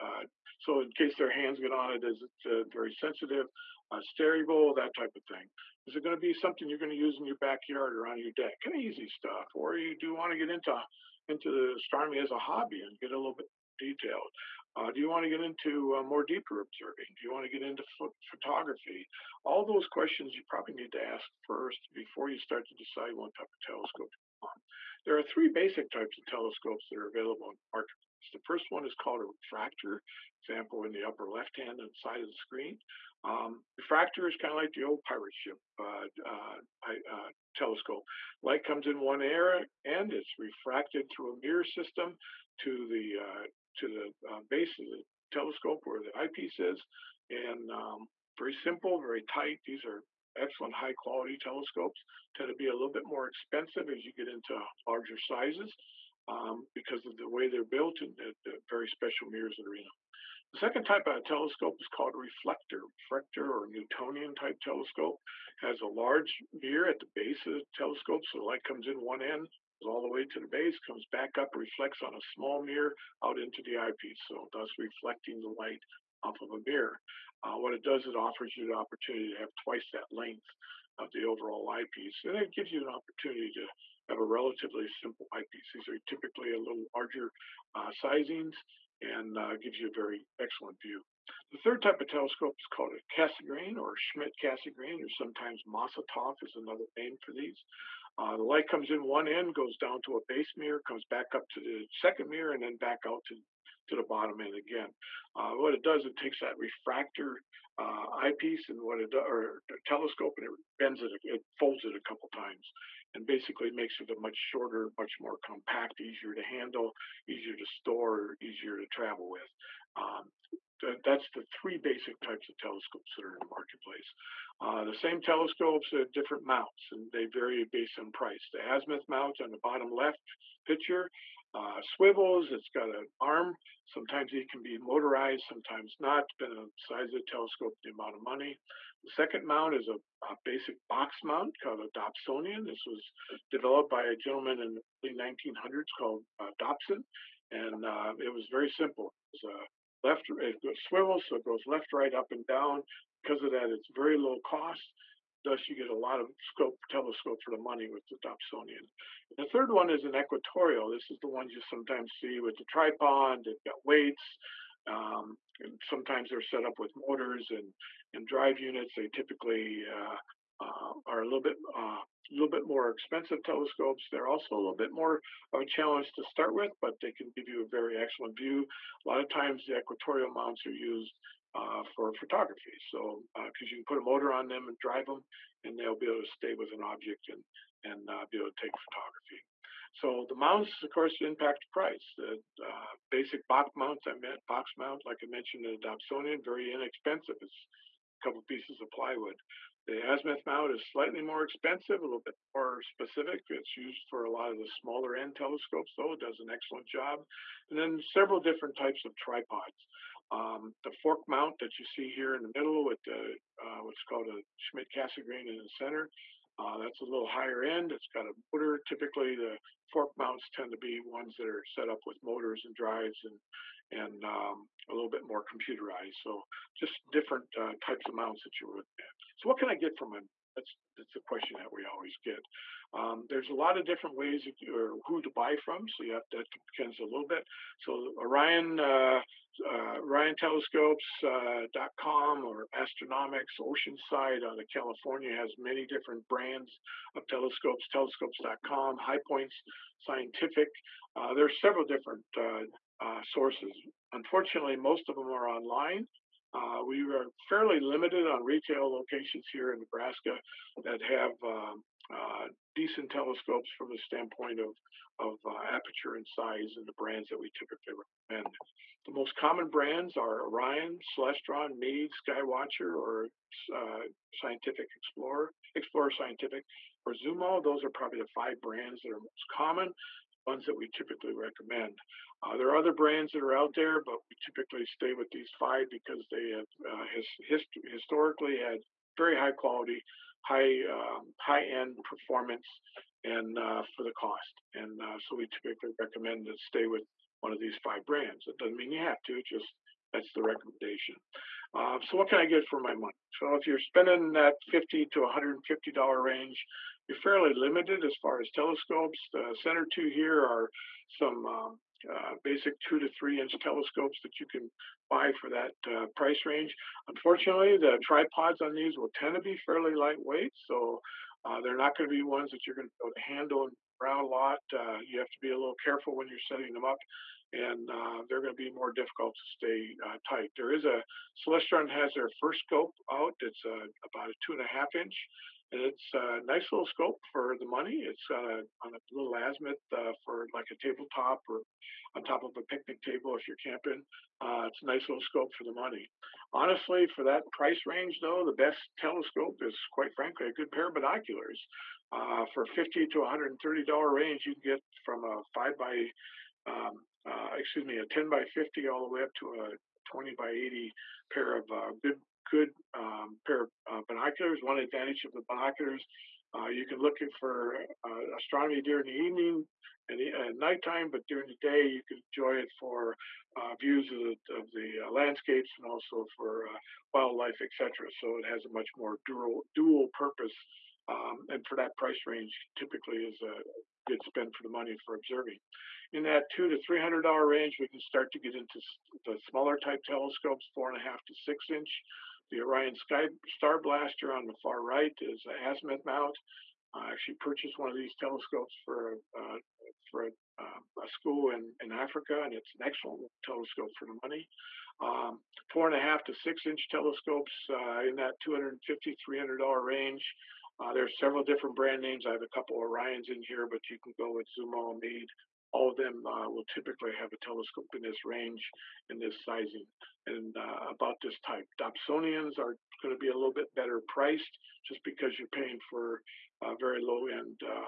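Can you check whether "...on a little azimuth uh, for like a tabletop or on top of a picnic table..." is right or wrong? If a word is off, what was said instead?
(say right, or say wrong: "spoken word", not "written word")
right.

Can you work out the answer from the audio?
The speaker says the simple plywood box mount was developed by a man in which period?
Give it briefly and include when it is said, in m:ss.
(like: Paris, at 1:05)
Early 1900s, at 2:25.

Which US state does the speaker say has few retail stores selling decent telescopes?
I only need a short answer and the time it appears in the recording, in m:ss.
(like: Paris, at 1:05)
Nebraska, at 4:19.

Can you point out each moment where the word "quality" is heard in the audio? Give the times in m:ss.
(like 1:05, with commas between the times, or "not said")
0:50, 4:49.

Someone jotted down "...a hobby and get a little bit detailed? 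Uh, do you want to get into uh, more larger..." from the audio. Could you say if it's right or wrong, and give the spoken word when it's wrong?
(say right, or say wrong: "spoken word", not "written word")
wrong: "deeper", not "larger".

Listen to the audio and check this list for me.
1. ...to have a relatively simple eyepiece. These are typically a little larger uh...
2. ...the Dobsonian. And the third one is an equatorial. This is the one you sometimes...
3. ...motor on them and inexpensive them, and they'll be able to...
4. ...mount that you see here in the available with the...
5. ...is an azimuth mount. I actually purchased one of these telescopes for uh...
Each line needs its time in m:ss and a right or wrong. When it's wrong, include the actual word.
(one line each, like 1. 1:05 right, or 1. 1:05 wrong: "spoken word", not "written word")
1. 1:23 right
2. 2:38 right
3. 3:04 wrong: "drive", not "inexpensive"
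4. 3:31 wrong: "middle", not "available"
5. 6:35 right.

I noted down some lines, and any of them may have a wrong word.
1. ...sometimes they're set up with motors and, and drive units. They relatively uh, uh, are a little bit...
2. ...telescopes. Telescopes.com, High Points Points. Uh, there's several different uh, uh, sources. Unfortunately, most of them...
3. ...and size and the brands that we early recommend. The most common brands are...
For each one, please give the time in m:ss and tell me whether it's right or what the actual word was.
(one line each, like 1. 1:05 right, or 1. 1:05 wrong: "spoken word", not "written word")
1. 2:45 wrong: "typically", not "relatively"
2. 4:07 wrong: "Scientific", not "Points"
3. 4:26 wrong: "typically", not "early".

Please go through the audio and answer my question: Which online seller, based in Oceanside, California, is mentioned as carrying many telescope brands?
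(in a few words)
Astronomics.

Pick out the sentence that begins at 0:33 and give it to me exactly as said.
Um, refractor is kind of like the old pirate ship uh, uh, uh, telescope.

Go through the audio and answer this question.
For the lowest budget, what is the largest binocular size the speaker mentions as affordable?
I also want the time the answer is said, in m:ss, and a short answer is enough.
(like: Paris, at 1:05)
20x80, at 6:00.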